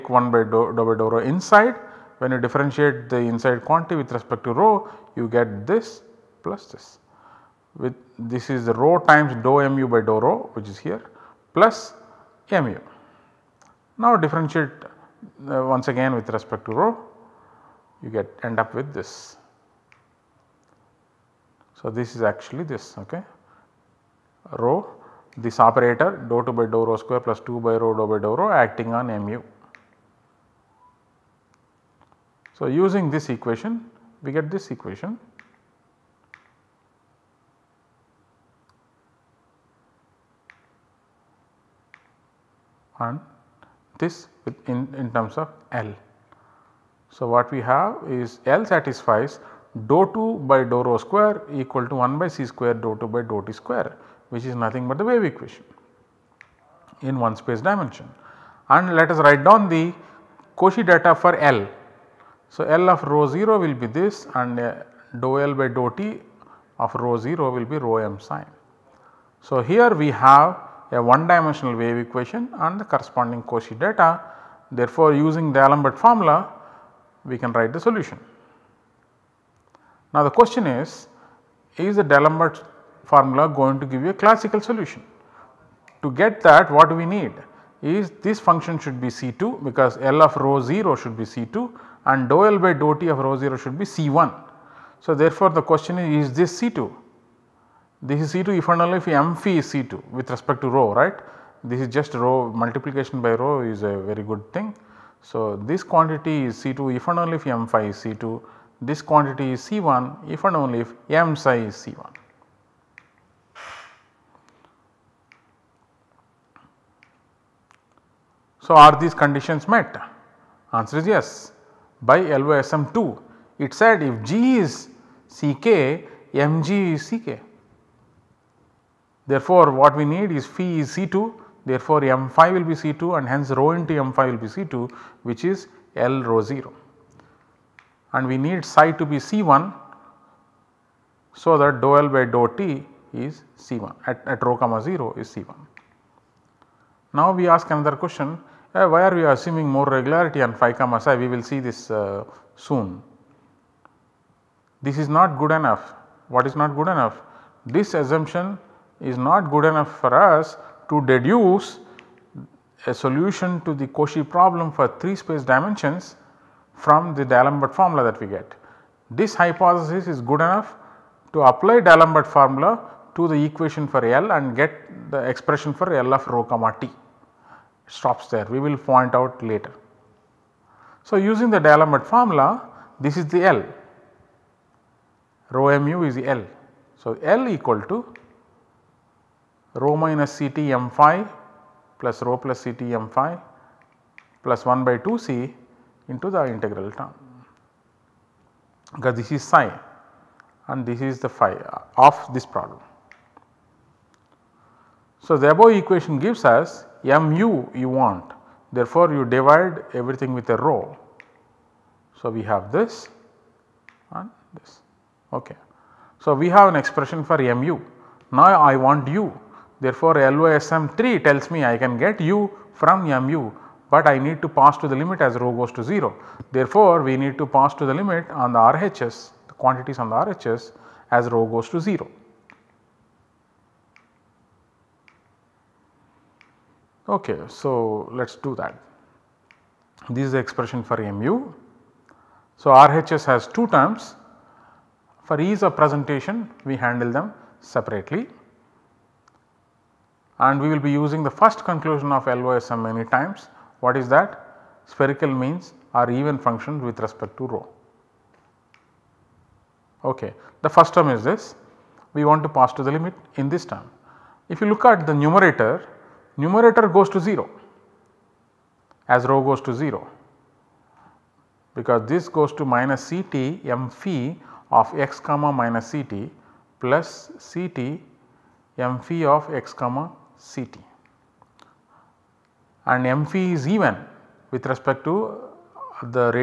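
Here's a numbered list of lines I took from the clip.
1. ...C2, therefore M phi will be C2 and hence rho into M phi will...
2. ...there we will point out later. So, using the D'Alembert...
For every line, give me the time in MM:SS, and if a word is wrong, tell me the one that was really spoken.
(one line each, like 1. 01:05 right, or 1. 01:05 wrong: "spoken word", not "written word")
1. 02:10 right
2. 02:58 right.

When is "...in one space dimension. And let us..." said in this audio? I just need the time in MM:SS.
00:57.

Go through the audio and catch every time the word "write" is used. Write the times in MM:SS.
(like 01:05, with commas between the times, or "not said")
00:59, 01:17.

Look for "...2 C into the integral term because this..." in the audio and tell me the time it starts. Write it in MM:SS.
03:14.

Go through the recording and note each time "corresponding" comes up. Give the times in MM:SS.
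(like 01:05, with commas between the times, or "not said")
01:12.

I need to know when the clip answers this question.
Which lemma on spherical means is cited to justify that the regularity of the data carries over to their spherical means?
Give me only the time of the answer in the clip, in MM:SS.
02:02.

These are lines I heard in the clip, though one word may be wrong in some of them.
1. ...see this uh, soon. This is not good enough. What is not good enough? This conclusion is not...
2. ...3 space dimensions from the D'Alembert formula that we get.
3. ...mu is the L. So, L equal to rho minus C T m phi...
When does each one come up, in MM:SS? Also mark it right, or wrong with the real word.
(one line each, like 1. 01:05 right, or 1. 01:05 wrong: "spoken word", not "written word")
1. 02:31 wrong: "assumption", not "conclusion"
2. 02:44 right
3. 03:05 right.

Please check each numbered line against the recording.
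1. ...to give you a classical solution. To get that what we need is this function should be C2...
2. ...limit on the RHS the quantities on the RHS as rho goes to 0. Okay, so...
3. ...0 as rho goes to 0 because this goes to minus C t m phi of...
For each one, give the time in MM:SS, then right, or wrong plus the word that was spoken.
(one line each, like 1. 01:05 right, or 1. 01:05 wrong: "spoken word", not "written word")
1. 01:23 right
2. 03:47 right
3. 04:27 right.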